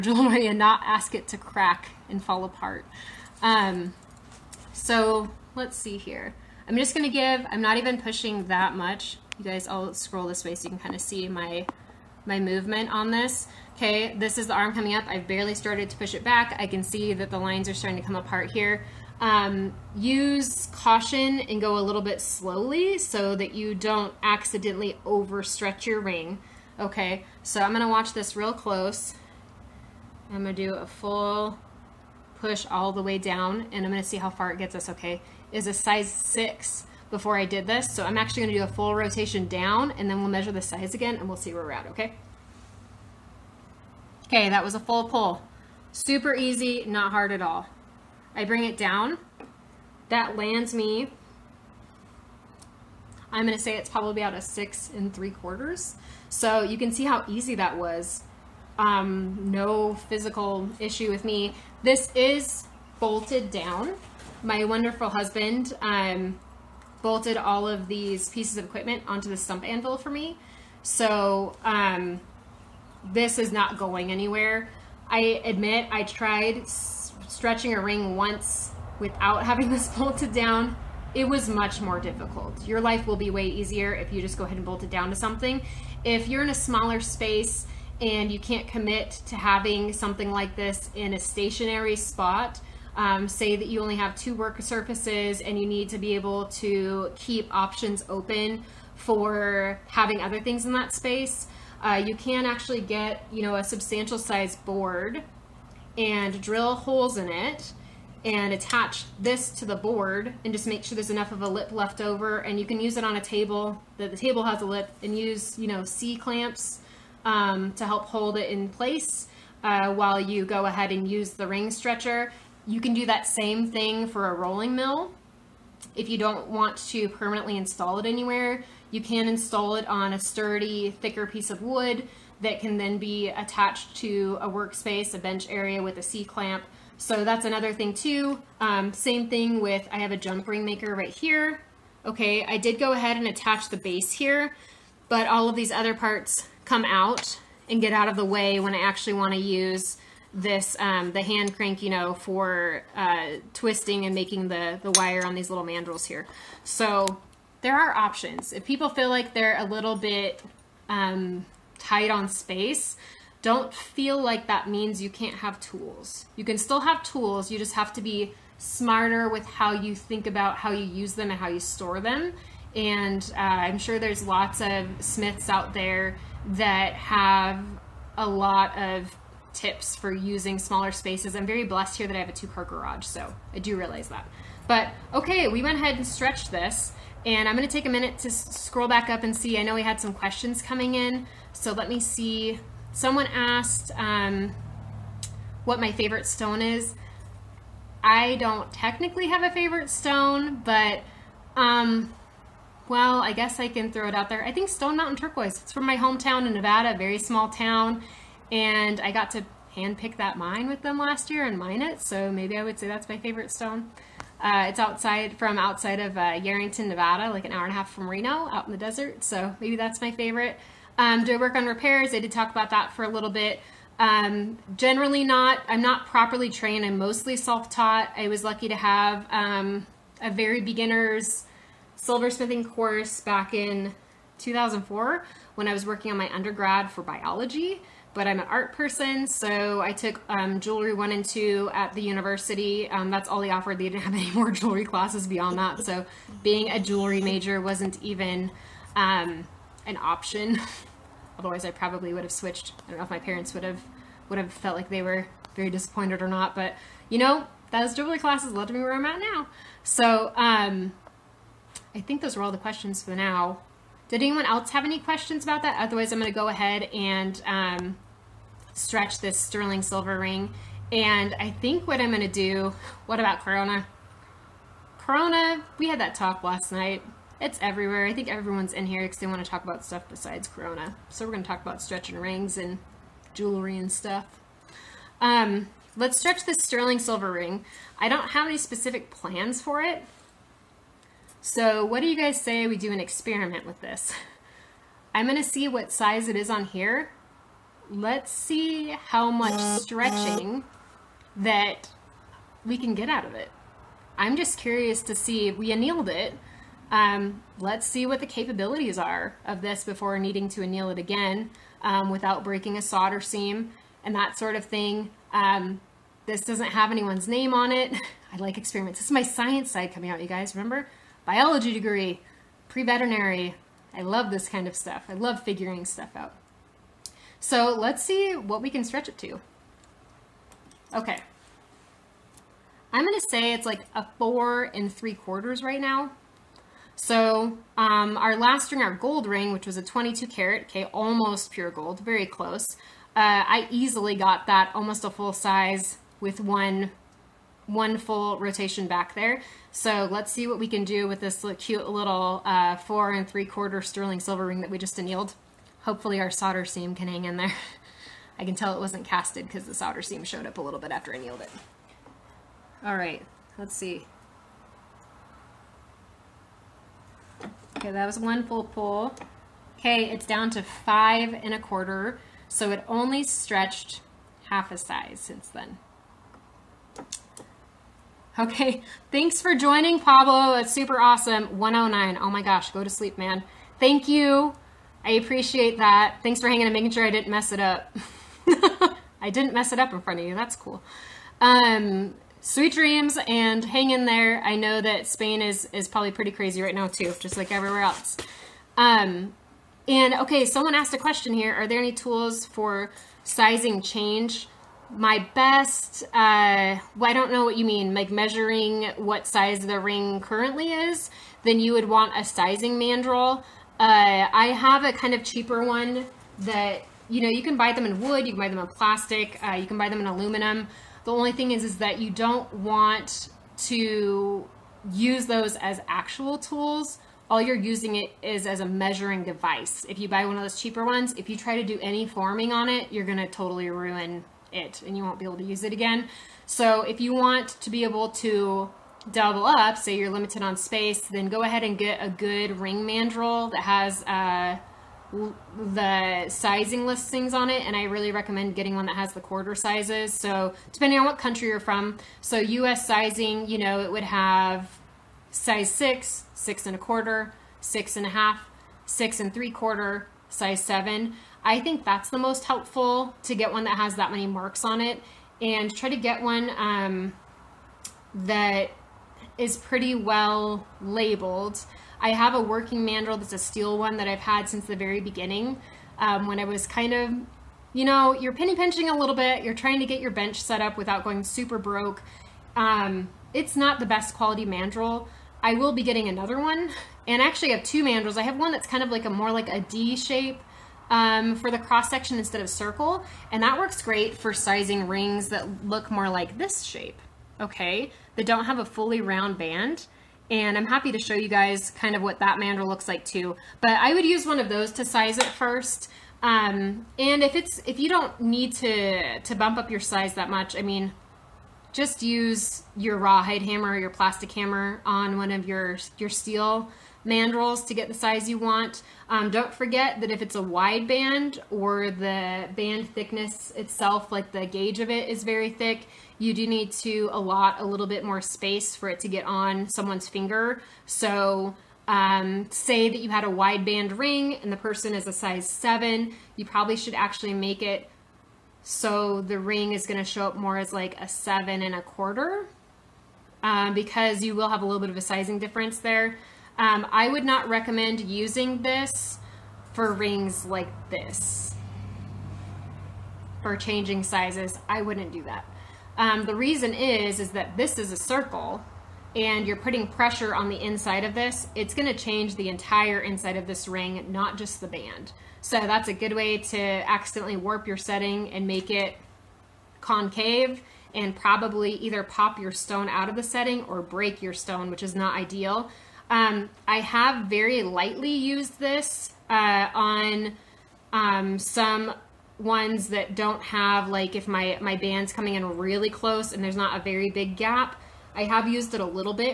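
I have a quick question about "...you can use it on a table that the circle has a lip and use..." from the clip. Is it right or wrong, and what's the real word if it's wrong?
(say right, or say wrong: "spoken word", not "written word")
wrong: "table", not "circle".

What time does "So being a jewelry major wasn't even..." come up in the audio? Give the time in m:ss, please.
4:05.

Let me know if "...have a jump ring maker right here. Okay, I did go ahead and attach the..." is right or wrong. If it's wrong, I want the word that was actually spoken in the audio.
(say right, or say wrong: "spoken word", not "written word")
right.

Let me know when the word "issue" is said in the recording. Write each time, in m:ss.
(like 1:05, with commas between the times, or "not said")
1:00.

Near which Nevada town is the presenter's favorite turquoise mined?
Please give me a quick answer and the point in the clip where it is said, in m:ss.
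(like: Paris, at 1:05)
Yerington, at 3:36.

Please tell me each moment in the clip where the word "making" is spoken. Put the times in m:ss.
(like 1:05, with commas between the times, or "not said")
2:34, 6:26.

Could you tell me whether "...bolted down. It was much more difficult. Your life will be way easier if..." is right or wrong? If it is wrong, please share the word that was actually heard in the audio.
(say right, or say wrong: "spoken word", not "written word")
right.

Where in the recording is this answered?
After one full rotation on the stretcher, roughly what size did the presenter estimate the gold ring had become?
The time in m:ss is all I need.
0:54.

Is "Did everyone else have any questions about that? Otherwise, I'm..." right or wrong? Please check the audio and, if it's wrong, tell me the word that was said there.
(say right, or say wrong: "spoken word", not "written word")
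wrong: "anyone", not "everyone".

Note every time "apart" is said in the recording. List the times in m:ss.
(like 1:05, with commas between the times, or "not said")
0:02, 0:18.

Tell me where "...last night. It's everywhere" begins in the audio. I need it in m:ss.
4:36.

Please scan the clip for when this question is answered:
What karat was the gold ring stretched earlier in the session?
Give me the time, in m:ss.
5:39.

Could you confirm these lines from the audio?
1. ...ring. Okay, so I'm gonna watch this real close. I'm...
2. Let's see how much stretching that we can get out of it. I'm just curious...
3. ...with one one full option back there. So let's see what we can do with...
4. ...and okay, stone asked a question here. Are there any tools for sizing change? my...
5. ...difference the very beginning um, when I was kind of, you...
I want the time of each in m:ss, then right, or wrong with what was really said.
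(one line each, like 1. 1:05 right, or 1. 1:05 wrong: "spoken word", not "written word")
1. 0:25 right
2. 4:57 right
3. 5:46 wrong: "rotation", not "option"
4. 6:39 wrong: "someone", not "stone"
5. 7:54 wrong: "since", not "difference".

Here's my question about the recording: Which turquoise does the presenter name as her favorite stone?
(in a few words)
Stone Mountain Turquoise.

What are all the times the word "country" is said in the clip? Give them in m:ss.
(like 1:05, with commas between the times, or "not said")
7:31.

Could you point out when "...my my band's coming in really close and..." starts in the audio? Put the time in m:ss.
9:44.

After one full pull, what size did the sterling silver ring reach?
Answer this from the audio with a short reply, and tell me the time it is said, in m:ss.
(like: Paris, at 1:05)
5 and a quarter, at 6:10.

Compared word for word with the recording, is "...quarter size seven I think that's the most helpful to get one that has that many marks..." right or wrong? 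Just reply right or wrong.
right.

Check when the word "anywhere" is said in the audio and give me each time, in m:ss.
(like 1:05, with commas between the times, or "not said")
1:14, 2:08.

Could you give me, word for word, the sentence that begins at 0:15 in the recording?
I've barely started to push it back.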